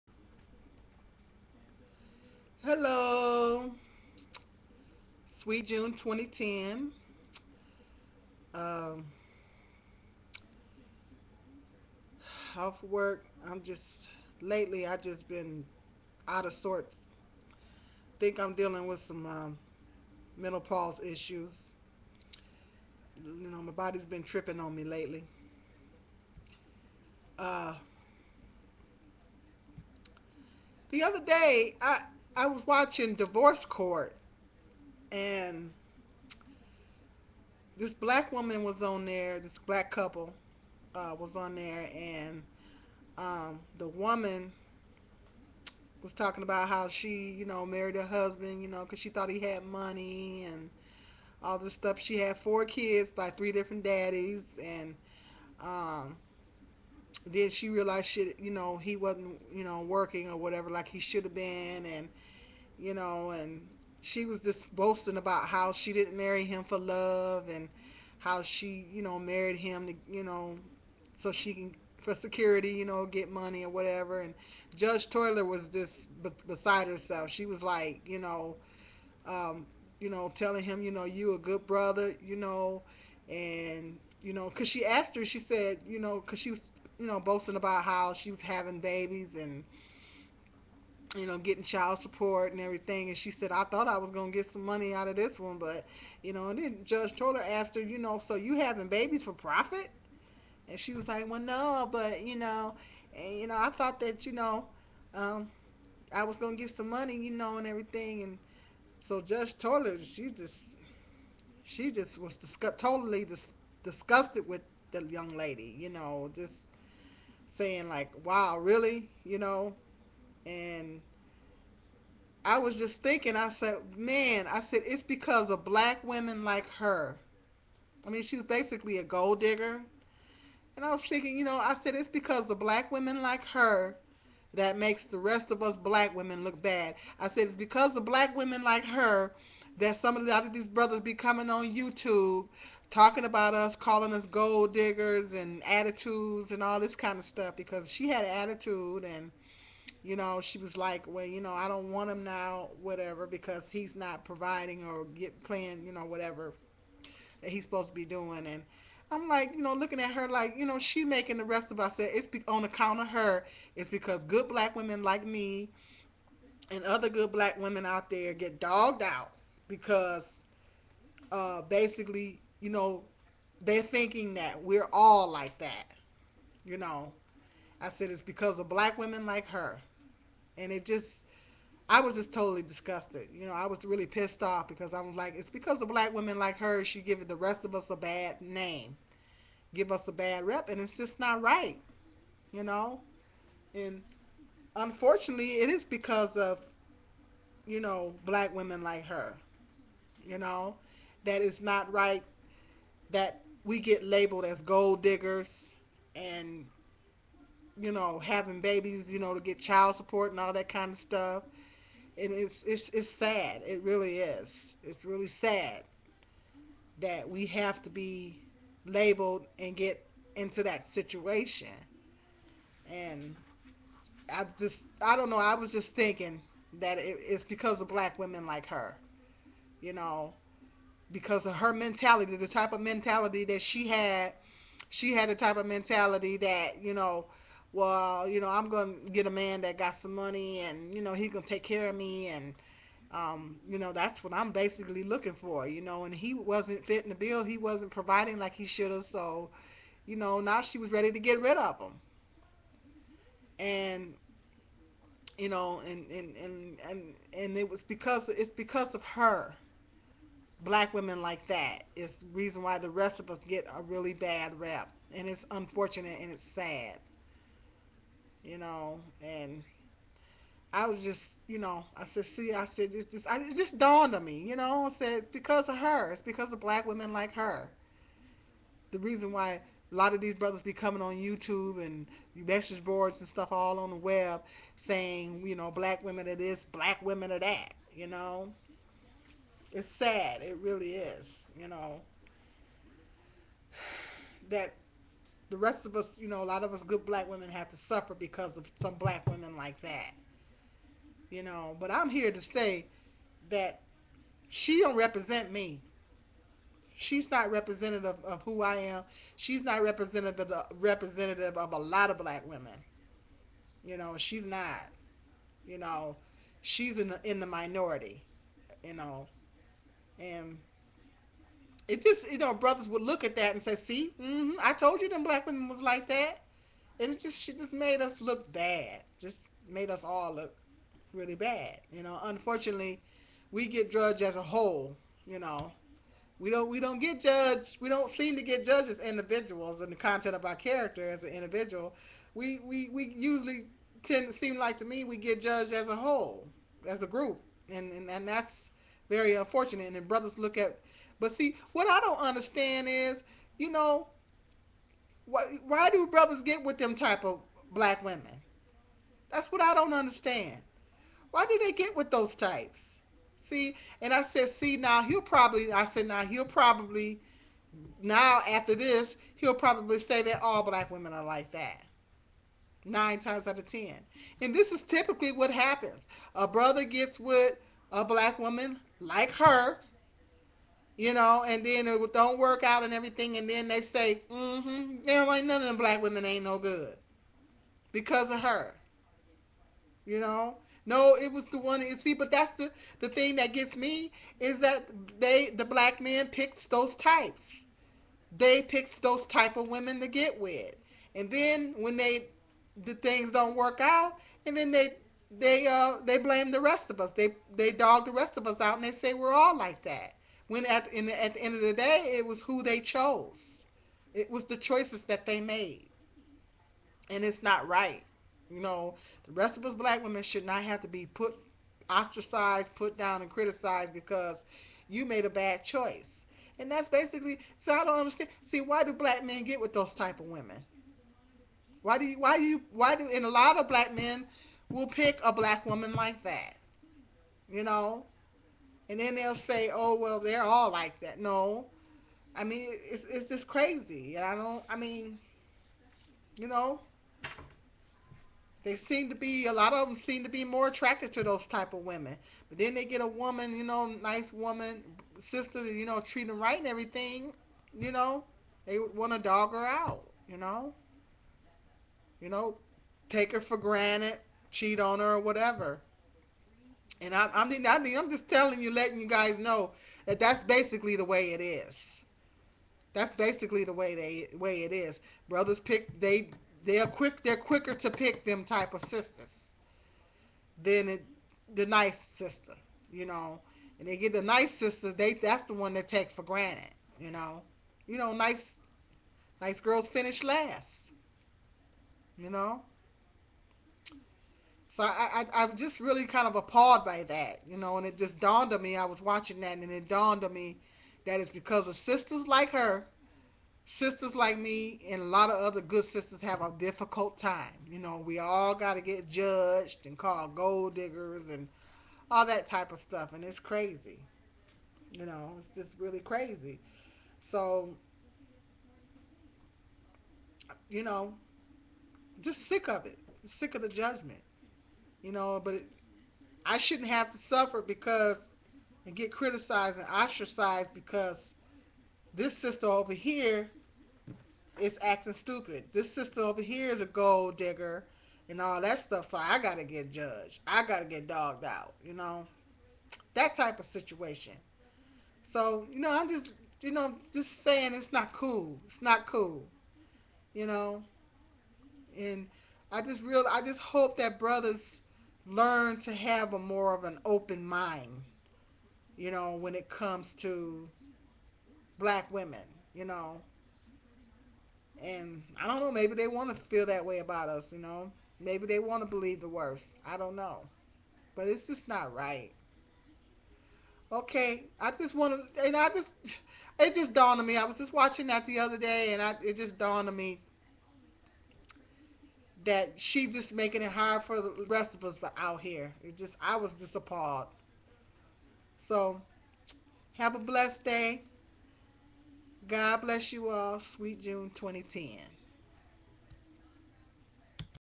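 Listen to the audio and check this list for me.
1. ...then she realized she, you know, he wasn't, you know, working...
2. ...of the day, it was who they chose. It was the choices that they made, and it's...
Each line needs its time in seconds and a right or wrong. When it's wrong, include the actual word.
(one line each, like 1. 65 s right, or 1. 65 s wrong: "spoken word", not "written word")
1. 57 s right
2. 411 s right.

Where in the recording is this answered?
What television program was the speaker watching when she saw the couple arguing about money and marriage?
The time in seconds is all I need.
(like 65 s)
33 s.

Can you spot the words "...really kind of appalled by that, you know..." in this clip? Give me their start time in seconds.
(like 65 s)
495 s.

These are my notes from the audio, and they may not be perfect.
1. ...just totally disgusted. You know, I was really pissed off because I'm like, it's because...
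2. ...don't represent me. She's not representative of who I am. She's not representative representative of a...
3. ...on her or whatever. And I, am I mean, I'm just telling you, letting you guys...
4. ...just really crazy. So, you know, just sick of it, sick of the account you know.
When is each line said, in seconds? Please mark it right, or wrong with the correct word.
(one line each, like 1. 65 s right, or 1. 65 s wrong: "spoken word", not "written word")
1. 182 s right
2. 304 s right
3. 464 s right
4. 515 s wrong: "judgment", not "account".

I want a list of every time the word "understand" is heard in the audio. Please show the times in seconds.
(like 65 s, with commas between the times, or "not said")
352 s, 359 s, 427 s.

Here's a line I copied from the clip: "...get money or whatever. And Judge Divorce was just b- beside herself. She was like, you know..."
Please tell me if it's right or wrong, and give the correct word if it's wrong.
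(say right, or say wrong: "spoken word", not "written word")
wrong: "Toler", not "Divorce".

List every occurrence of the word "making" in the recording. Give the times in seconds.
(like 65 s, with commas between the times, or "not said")
161 s, 583 s.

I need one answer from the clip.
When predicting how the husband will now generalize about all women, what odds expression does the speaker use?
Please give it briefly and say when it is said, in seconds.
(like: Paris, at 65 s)
Nine times out of ten, at 372 s.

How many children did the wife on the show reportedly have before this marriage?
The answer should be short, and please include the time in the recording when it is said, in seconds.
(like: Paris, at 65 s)
4, at 52 s.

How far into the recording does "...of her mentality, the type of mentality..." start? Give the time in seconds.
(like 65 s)
231 s.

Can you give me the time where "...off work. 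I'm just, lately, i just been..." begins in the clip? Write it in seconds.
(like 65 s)
12 s.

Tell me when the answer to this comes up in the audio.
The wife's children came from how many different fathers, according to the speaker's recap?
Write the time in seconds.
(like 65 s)
53 s.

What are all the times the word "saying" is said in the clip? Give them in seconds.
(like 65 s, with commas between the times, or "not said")
117 s, 284 s, 547 s.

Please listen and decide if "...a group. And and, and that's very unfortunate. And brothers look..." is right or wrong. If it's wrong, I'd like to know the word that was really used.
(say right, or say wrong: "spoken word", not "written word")
right.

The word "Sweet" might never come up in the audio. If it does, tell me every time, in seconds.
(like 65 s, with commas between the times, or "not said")
5 s, 593 s.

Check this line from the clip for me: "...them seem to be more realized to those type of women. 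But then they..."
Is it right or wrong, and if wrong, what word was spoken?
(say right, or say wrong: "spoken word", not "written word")
wrong: "attracted", not "realized".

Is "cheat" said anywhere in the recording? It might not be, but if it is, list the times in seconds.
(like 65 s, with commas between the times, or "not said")
464 s.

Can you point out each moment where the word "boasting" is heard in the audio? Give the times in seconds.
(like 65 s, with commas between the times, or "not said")
64 s, 87 s.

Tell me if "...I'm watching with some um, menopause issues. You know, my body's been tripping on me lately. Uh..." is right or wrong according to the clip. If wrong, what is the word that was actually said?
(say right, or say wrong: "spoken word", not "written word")
wrong: "dealing", not "watching".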